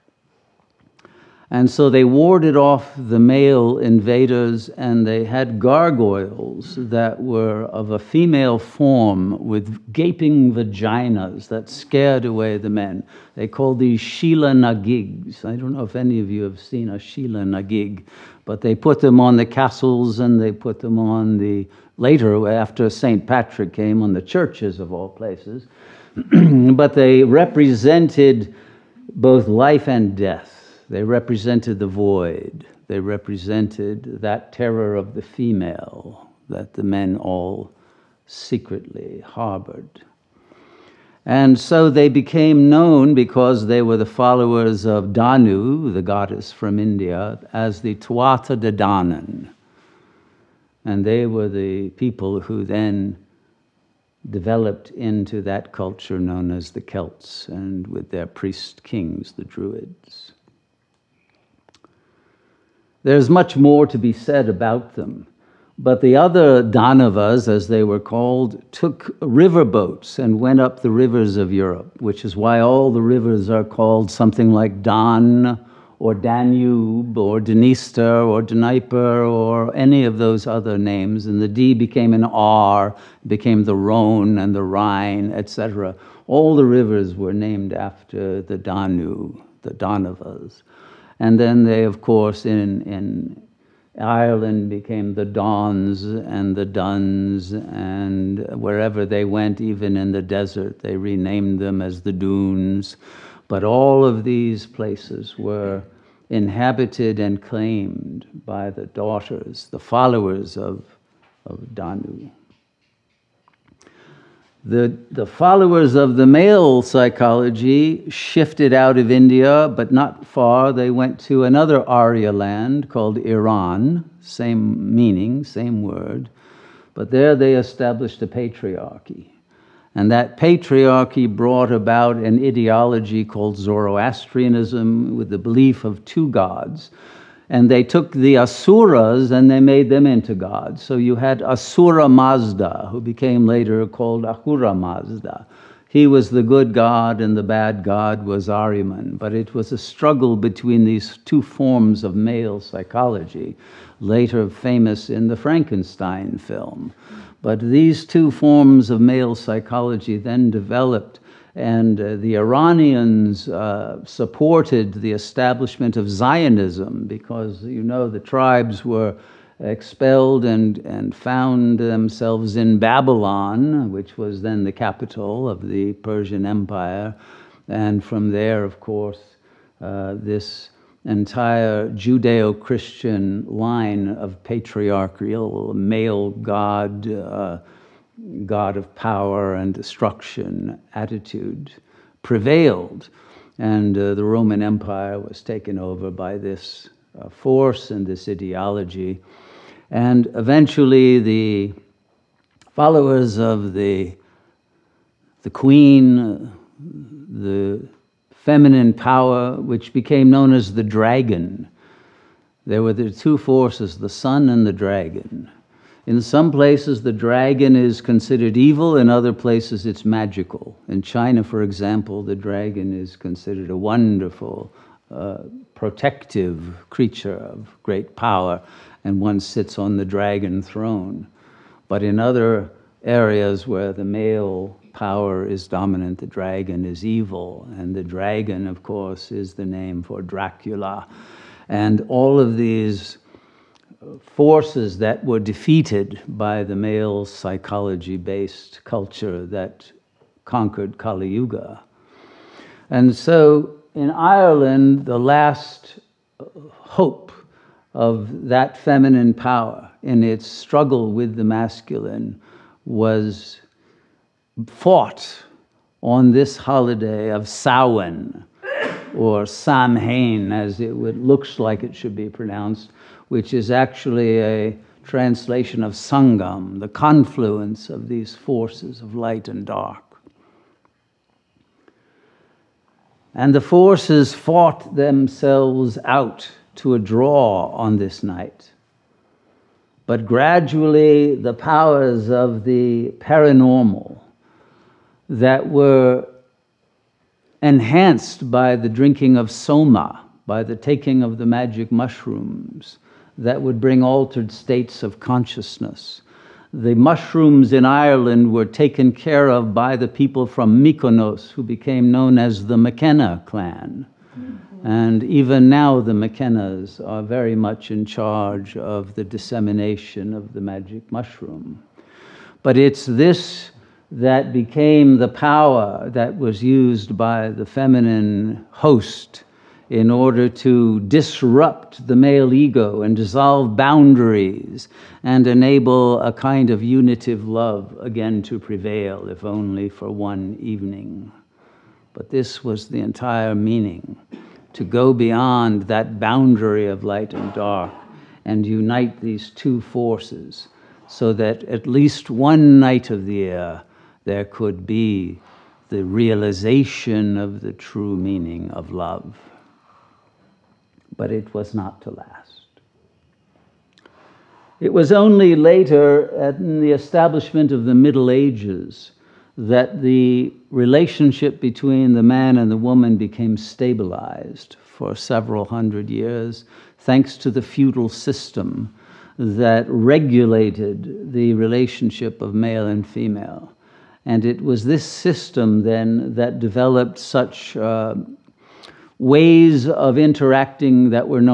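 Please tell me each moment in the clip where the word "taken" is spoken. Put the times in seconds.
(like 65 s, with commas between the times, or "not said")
195 s, 308 s.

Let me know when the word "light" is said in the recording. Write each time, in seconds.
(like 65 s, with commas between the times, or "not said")
279 s, 347 s.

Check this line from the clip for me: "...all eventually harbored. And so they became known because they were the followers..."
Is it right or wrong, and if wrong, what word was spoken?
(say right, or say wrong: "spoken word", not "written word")
wrong: "secretly", not "eventually".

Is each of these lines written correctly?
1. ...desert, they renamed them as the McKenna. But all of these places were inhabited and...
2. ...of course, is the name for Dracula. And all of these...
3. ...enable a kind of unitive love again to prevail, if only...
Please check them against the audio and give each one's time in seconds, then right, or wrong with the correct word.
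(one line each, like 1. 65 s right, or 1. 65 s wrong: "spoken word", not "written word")
1. 100 s wrong: "Dunes", not "McKenna"
2. 238 s right
3. 335 s right.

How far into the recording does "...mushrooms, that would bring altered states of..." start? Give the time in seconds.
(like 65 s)
301 s.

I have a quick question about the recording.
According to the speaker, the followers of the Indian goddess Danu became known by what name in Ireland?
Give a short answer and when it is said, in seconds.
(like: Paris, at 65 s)
Tuatha De Danann, at 47 s.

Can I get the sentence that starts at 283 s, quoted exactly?
And the forces fought themselves out to a draw on this night.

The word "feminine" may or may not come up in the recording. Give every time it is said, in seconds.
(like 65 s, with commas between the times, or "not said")
208 s, 258 s, 327 s.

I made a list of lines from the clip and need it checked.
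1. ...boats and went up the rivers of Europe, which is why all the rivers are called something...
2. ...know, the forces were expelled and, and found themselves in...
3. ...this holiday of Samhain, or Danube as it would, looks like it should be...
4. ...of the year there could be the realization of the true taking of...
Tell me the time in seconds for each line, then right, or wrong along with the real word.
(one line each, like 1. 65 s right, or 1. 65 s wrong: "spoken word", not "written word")
1. 69 s right
2. 167 s wrong: "tribes", not "forces"
3. 266 s wrong: "Samhain", not "Danube"
4. 353 s wrong: "meaning", not "taking".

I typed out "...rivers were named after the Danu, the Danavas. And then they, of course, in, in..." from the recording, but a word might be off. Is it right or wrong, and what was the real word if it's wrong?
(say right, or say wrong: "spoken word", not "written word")
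right.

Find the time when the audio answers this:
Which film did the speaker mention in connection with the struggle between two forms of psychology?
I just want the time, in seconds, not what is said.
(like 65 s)
155 s.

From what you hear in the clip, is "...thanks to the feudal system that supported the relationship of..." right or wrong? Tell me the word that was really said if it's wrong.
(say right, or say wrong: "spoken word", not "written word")
wrong: "regulated", not "supported".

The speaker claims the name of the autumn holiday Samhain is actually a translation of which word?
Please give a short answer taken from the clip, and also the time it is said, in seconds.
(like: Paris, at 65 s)
Sangam, at 275 s.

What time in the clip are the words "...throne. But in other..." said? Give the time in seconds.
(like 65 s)
230 s.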